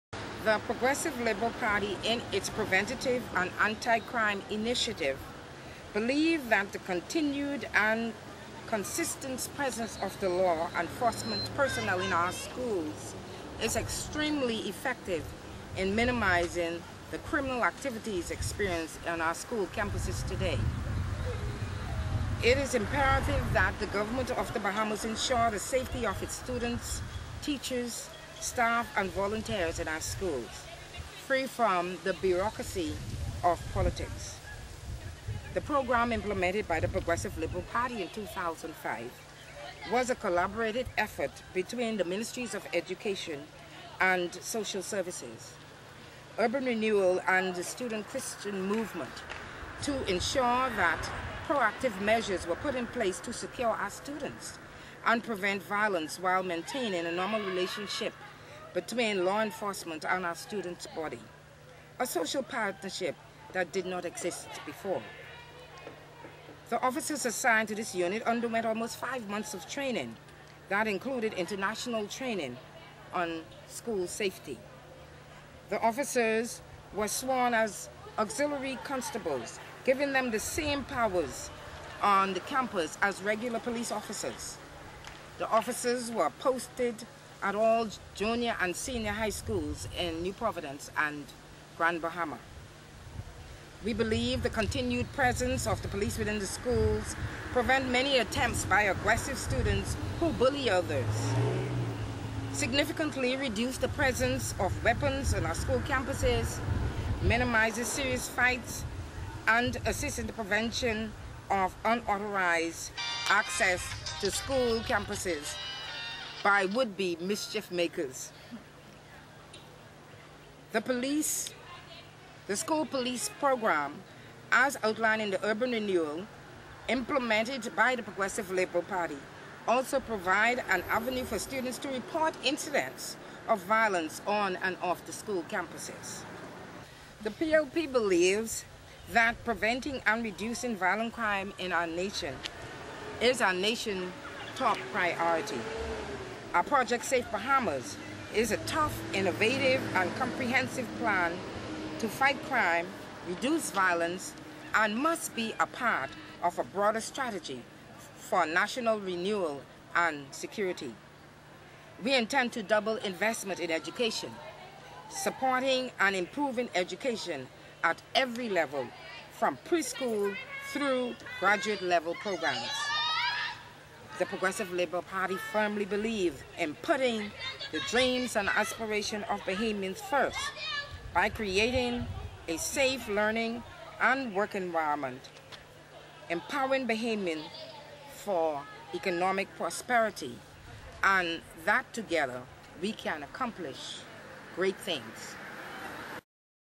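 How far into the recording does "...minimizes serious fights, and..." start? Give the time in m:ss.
1:47.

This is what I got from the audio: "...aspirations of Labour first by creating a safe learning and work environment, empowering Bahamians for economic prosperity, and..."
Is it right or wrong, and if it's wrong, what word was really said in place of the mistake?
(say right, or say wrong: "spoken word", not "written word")
wrong: "Bahamians", not "Labour".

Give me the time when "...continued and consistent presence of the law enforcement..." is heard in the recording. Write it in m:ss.
0:06.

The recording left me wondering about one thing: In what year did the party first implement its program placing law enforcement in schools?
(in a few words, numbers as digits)
2005.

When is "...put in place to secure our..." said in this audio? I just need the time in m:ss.
0:52.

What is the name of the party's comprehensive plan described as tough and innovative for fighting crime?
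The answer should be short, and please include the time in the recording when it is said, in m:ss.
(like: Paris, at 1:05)
Project Safe Bahamas, at 2:26.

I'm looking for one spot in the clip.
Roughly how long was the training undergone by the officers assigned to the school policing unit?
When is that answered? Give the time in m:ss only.
1:08.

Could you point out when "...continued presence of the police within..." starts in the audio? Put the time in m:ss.
1:34.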